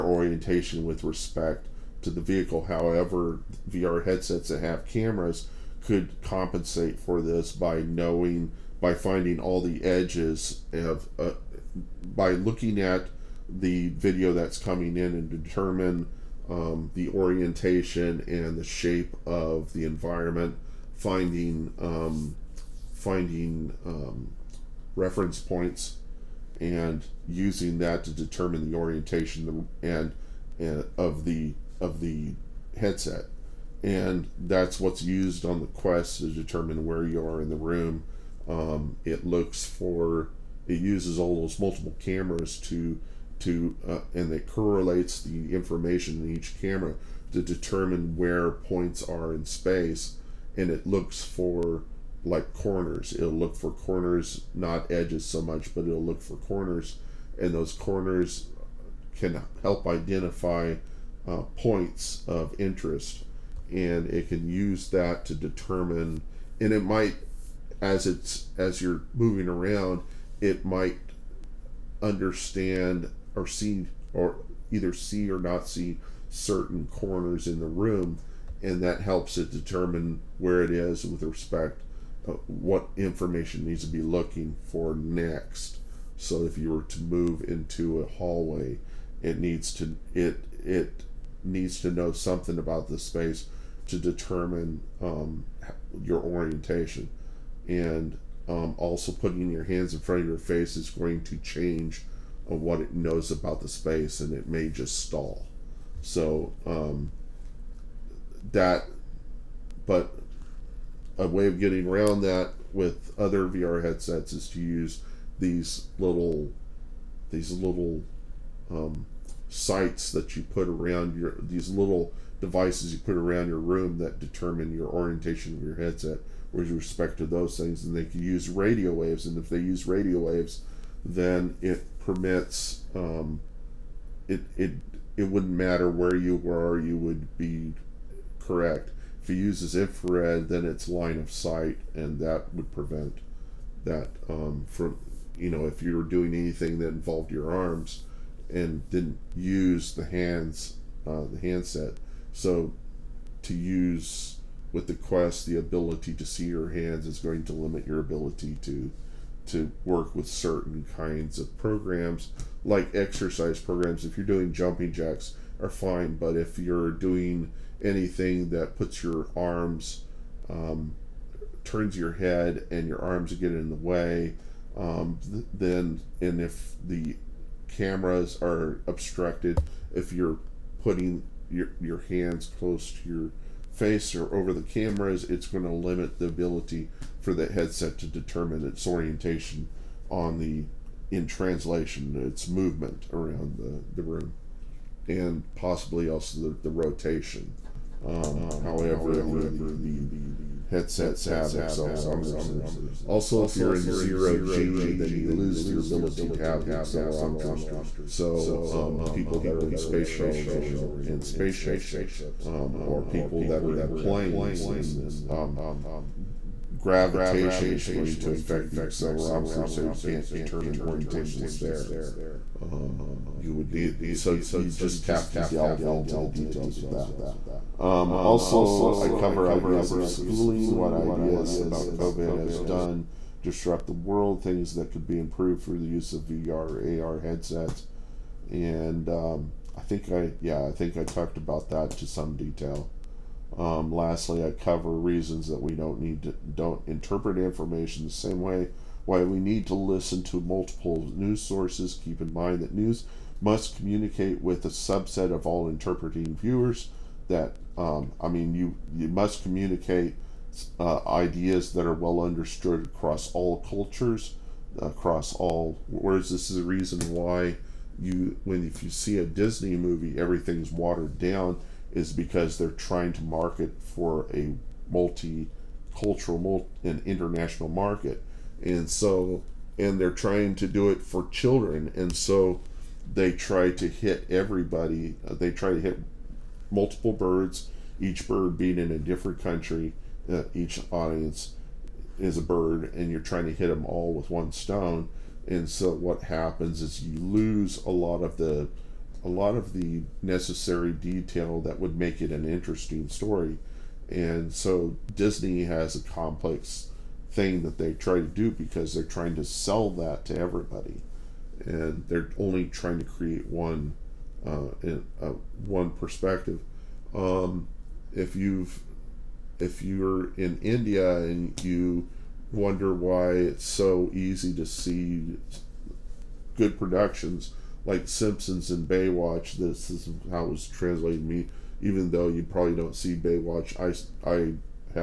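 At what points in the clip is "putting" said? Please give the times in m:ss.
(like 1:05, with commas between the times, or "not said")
1:39, 3:00.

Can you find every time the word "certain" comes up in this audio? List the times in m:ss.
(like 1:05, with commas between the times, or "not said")
1:16, 2:40.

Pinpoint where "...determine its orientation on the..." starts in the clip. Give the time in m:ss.
3:08.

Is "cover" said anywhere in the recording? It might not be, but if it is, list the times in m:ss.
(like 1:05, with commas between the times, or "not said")
3:49, 4:04.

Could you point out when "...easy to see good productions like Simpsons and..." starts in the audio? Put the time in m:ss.
5:24.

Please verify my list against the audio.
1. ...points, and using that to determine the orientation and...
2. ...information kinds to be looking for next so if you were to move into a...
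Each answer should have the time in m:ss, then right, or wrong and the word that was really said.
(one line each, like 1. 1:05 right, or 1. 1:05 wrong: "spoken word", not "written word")
1. 0:25 right
2. 1:22 wrong: "needs", not "kinds".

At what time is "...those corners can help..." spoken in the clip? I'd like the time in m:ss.
0:57.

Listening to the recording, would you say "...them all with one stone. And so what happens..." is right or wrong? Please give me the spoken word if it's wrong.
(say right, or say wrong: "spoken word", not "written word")
right.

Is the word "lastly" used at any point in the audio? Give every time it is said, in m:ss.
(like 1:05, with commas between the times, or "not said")
4:03.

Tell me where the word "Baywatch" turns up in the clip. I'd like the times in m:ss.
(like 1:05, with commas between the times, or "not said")
5:28, 5:33.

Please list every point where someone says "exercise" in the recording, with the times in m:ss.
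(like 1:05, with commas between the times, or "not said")
2:42.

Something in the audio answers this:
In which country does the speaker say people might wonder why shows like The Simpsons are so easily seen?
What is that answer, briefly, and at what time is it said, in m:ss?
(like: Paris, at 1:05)
India, at 5:19.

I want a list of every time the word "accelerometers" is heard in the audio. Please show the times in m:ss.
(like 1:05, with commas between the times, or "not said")
3:21, 3:26, 3:38.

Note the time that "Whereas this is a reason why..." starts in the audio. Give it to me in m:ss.
4:25.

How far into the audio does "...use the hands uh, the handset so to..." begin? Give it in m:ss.
2:29.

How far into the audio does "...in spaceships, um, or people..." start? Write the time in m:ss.
3:31.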